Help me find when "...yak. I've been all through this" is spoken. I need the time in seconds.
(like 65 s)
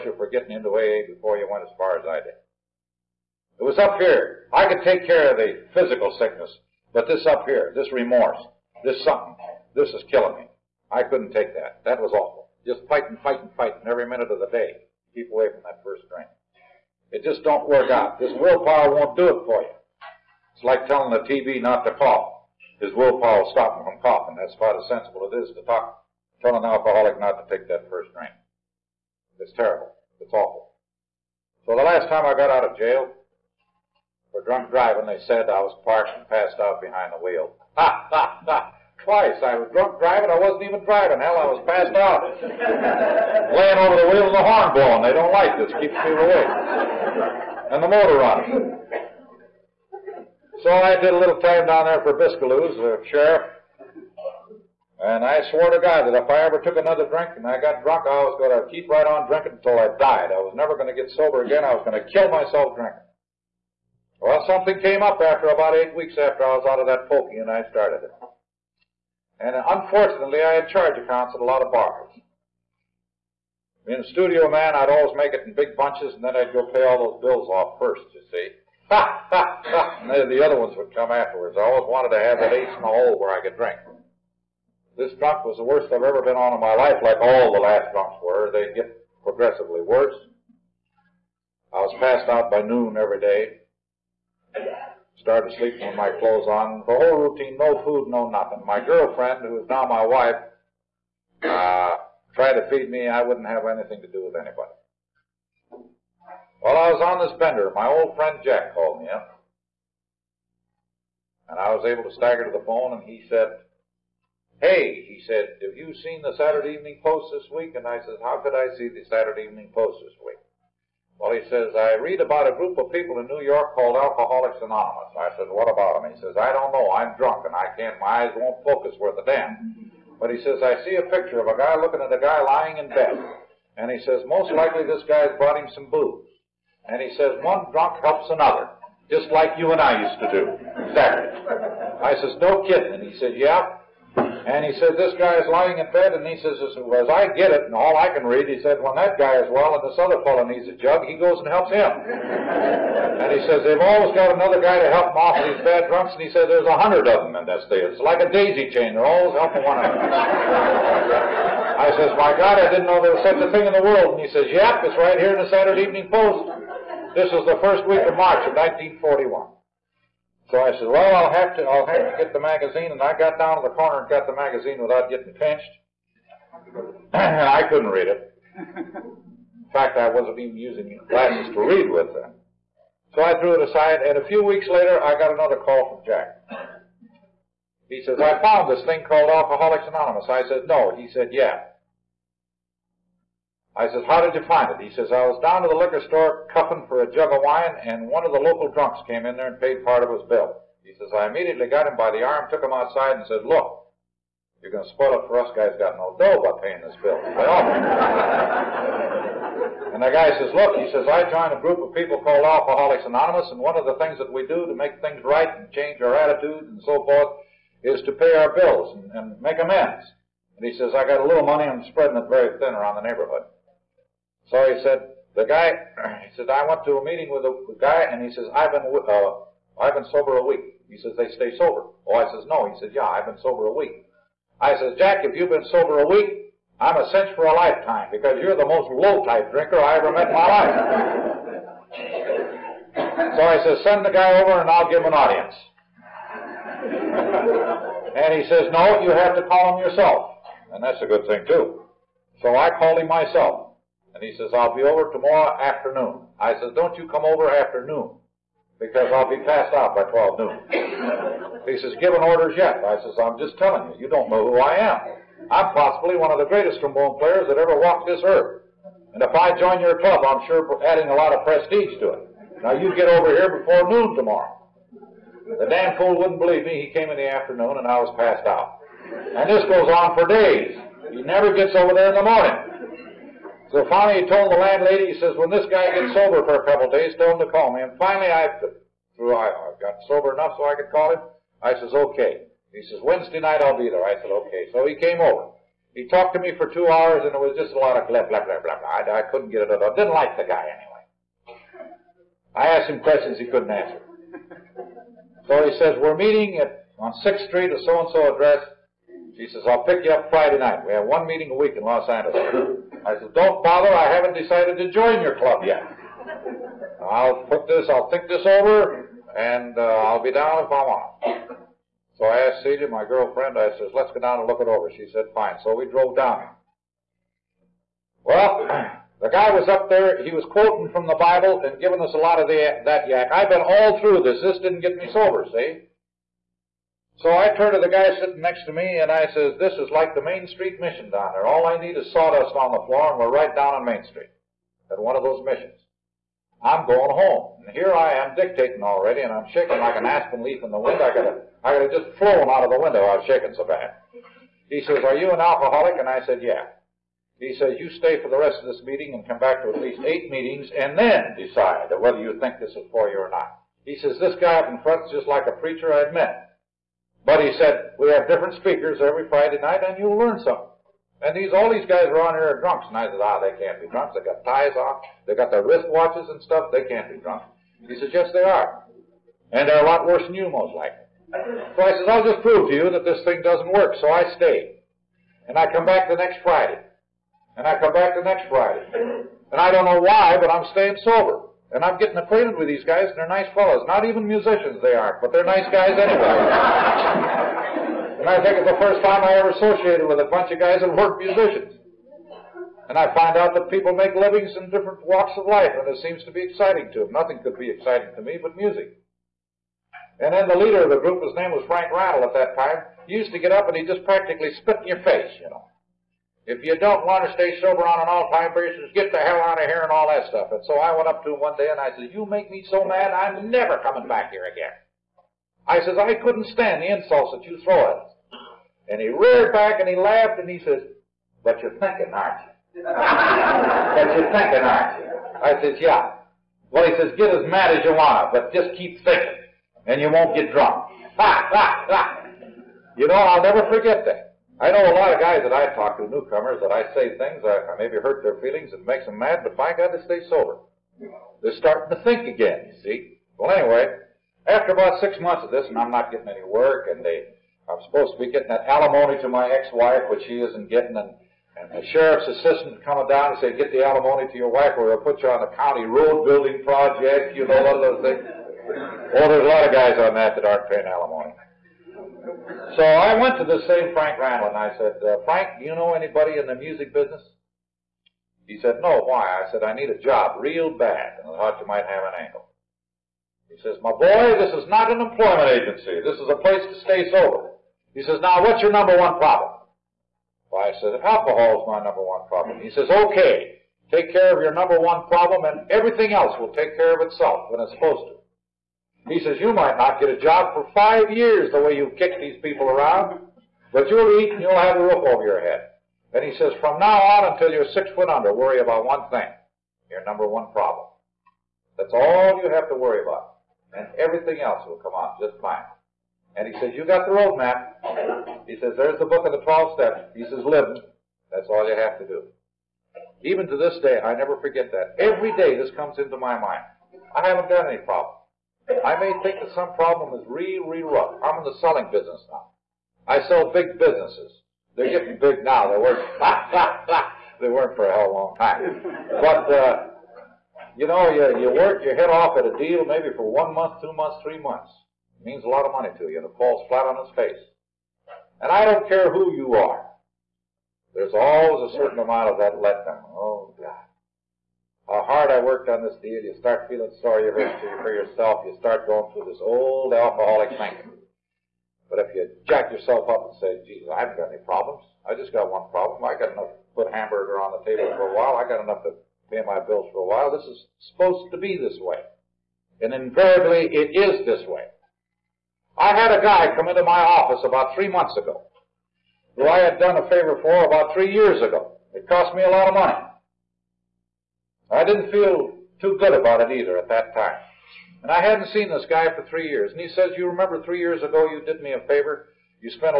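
333 s.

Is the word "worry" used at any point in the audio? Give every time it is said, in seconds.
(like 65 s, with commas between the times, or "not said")
508 s, 512 s.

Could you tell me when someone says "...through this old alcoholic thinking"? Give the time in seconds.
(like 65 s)
559 s.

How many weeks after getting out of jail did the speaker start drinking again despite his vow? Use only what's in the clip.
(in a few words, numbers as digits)
8.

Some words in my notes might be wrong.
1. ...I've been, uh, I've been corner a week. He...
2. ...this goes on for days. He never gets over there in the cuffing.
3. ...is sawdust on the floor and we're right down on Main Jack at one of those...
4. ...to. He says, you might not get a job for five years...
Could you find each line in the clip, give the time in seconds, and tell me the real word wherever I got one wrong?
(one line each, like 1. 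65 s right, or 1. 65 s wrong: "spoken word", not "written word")
1. 228 s wrong: "sober", not "corner"
2. 279 s wrong: "morning", not "cuffing"
3. 341 s wrong: "Street", not "Jack"
4. 498 s right.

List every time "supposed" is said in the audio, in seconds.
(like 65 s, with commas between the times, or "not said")
457 s, 497 s, 570 s.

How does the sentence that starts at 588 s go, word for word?
And I hadn't seen this guy for three years.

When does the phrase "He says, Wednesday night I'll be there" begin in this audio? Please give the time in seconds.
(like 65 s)
292 s.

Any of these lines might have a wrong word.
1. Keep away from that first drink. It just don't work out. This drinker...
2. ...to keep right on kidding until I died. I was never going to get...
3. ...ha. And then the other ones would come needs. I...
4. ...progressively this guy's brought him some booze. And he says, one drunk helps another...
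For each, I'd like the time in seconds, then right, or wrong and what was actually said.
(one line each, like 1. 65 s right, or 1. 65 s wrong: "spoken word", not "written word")
1. 15 s wrong: "willpower", not "drinker"
2. 58 s wrong: "drinking", not "kidding"
3. 79 s wrong: "afterwards", not "needs"
4. 134 s wrong: "likely", not "progressively".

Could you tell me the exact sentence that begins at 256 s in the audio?
I says, don't you come over after noon, because I'll be passed out by 12 noon.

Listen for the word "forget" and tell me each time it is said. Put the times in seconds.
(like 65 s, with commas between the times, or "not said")
443 s, 524 s.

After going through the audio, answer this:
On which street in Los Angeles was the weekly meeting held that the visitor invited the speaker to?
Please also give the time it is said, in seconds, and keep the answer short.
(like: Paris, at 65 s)
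6th Street, at 307 s.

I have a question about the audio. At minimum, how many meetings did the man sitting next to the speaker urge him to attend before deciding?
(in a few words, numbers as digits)
8.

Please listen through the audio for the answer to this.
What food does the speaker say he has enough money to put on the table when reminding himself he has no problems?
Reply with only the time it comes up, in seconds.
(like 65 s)
566 s.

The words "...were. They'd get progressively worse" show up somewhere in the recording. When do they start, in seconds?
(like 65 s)
88 s.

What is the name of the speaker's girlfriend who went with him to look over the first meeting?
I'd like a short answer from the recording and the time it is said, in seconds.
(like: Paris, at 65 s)
Celia, at 322 s.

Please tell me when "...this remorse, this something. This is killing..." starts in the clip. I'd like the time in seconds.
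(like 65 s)
7 s.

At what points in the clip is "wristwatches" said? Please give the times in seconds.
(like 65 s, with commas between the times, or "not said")
375 s.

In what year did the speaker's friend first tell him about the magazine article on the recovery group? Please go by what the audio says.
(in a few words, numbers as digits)
1941.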